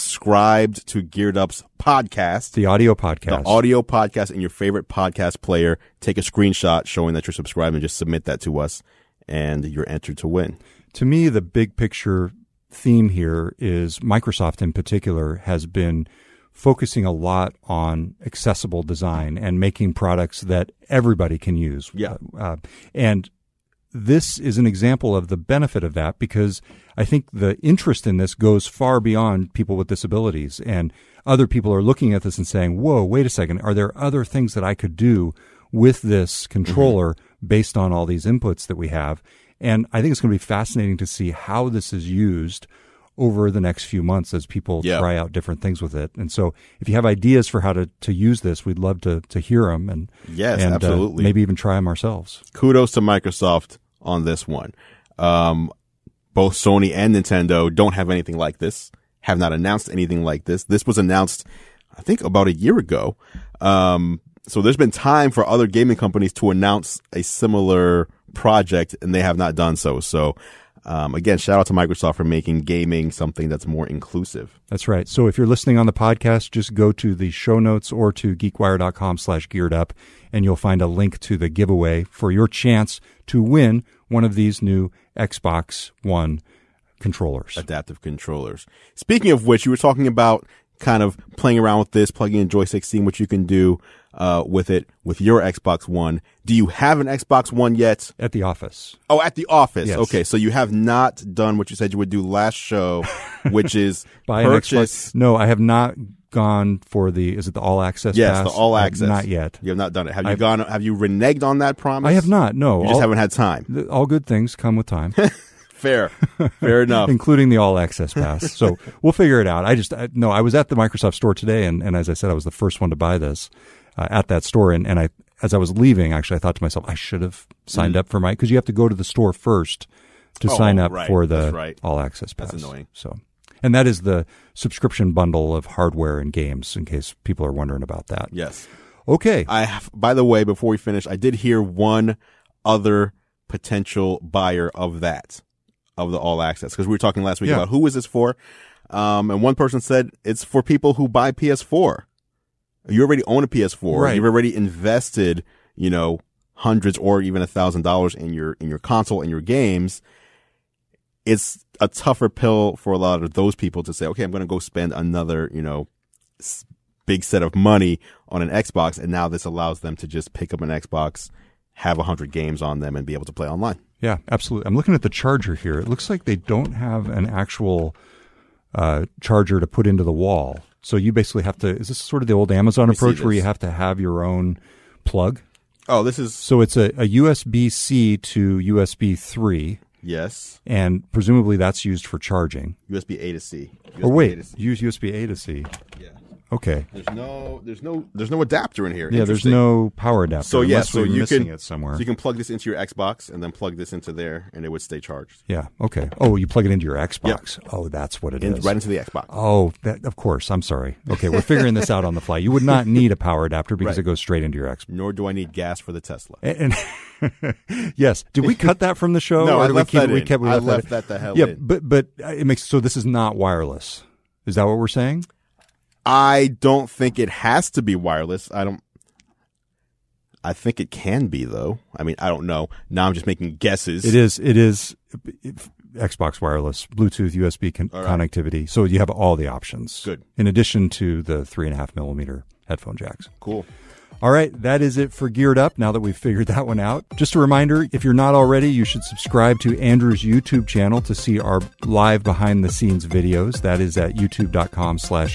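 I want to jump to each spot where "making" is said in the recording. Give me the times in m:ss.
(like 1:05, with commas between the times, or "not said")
0:19, 1:12, 3:53.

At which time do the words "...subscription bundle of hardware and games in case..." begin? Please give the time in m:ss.
2:14.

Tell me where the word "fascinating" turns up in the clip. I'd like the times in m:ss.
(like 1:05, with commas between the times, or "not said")
0:40.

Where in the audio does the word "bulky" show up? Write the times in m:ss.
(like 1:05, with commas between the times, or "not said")
not said.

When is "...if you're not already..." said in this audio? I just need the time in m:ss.
4:07.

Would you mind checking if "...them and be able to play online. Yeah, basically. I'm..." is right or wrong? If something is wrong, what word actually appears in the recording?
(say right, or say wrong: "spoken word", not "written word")
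wrong: "absolutely", not "basically".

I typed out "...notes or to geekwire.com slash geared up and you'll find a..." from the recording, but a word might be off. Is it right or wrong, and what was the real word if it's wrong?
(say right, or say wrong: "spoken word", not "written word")
right.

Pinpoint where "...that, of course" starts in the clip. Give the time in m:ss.
3:29.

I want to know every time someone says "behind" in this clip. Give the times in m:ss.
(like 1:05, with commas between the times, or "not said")
4:12.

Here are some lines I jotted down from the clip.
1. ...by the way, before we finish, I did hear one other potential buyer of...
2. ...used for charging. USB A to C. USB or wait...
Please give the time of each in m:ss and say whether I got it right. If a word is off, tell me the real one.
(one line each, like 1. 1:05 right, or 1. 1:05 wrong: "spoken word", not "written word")
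1. 2:19 right
2. 3:11 right.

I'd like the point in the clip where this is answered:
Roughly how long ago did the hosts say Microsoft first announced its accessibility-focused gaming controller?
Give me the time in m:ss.
1:02.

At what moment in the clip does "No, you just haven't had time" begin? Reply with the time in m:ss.
1:52.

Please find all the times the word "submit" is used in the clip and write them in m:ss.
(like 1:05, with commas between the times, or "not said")
0:07.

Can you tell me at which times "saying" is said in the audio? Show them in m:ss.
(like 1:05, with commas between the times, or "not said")
0:32, 3:44.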